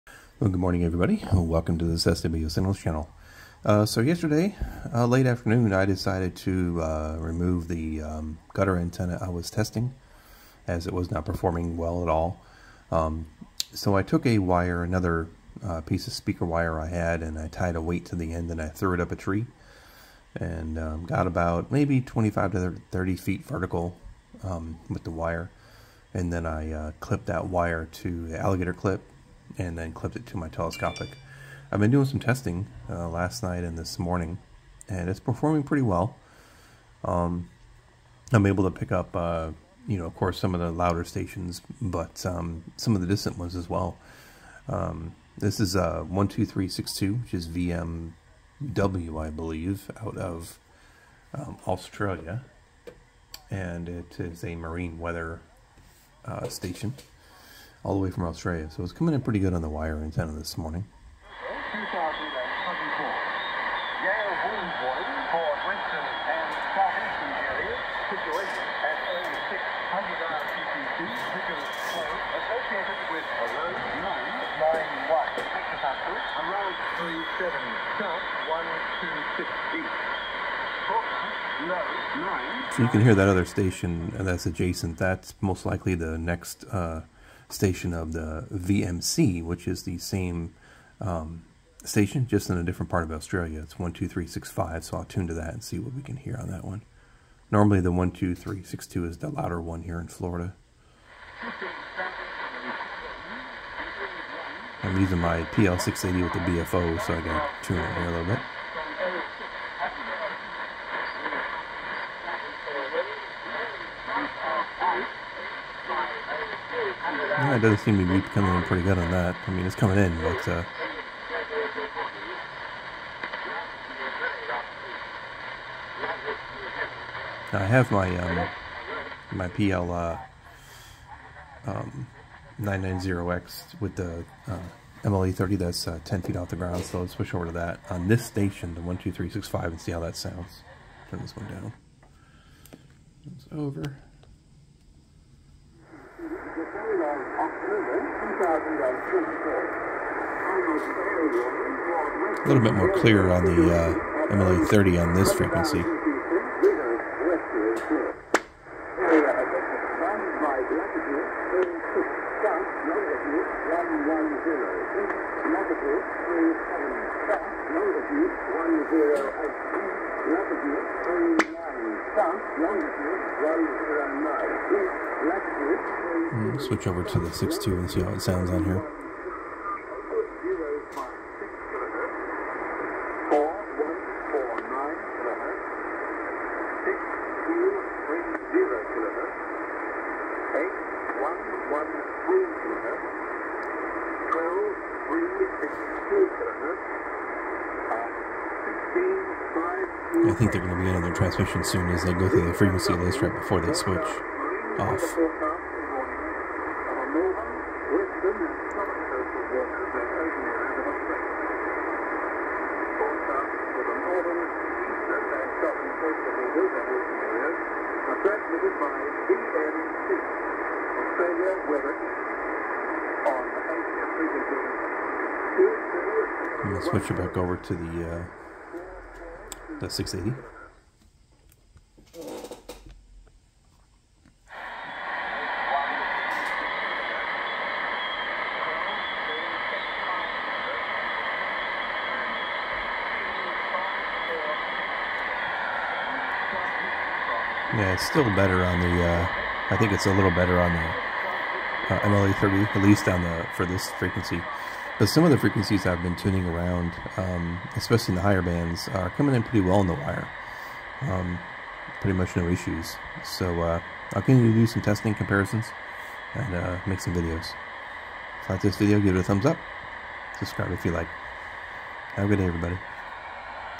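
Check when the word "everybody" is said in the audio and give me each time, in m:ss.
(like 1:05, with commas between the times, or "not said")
0:00, 4:32.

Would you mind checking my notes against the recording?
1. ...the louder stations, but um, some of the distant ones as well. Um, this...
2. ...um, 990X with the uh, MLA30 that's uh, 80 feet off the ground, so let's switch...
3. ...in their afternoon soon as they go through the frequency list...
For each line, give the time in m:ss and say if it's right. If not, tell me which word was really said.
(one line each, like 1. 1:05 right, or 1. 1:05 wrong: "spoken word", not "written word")
1. 0:40 right
2. 2:11 wrong: "10", not "80"
3. 3:20 wrong: "transmission", not "afternoon".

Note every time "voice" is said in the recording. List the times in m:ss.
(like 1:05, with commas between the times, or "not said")
not said.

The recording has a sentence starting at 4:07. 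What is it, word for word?
Yeah, it's still better on the.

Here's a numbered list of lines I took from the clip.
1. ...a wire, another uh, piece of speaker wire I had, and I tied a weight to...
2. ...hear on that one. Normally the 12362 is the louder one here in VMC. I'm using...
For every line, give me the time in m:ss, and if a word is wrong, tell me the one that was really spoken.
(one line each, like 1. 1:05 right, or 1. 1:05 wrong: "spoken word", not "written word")
1. 0:14 right
2. 1:36 wrong: "Florida", not "VMC".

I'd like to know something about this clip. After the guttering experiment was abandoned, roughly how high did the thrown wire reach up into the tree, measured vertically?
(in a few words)
25 to 30 feet.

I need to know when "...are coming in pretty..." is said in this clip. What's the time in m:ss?
4:18.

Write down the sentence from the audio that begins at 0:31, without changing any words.
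I've been doing some testing uh, last night and this morning, and it's performing pretty well.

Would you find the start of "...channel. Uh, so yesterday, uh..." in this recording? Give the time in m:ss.
0:02.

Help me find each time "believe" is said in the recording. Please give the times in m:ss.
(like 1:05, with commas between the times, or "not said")
0:49.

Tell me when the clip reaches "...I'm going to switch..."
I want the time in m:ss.
3:46.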